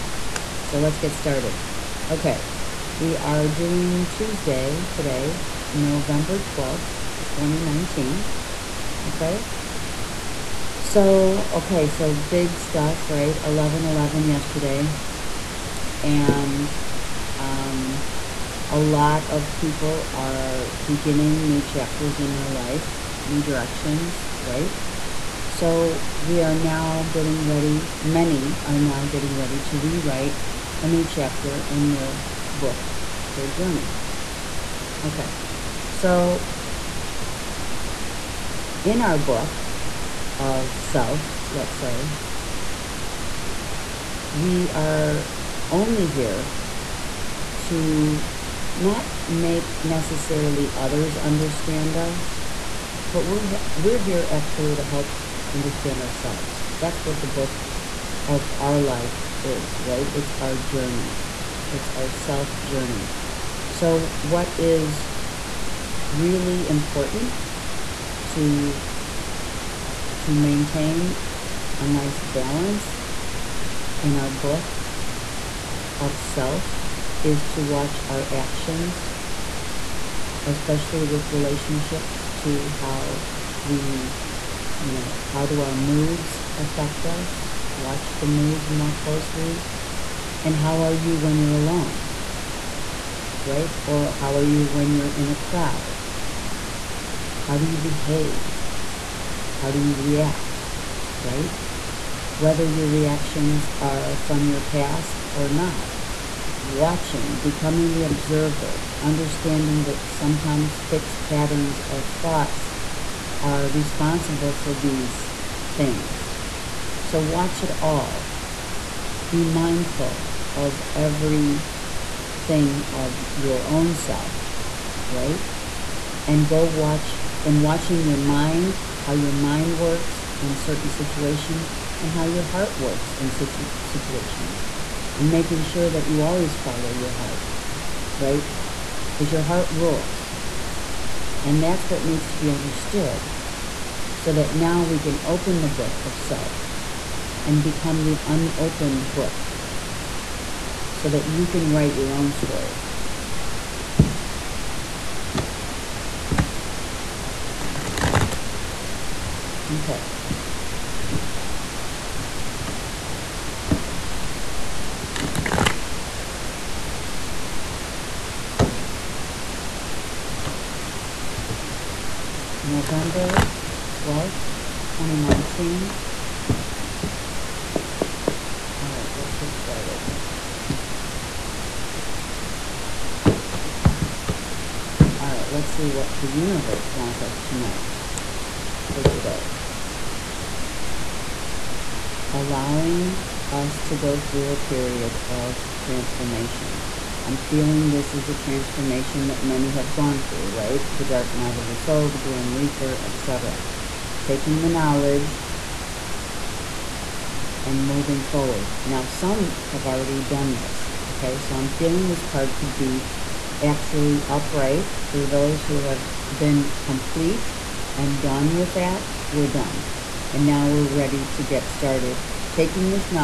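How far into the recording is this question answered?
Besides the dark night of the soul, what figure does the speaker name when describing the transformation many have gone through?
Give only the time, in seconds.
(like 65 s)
202 s.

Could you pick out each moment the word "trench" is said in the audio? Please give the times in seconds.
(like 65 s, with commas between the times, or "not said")
not said.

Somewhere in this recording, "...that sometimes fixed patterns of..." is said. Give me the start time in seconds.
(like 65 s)
109 s.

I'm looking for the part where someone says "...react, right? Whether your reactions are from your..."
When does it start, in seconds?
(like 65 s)
99 s.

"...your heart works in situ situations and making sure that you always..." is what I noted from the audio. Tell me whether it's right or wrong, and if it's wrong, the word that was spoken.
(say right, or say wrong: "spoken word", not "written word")
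right.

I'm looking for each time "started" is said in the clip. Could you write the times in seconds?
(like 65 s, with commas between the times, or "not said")
1 s, 179 s, 221 s.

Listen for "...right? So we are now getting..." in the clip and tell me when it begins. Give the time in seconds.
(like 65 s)
24 s.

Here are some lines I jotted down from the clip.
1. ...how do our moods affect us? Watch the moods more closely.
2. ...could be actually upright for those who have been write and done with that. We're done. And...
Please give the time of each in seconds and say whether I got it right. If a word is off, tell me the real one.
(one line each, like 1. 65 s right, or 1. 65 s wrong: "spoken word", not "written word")
1. 85 s right
2. 212 s wrong: "complete", not "write".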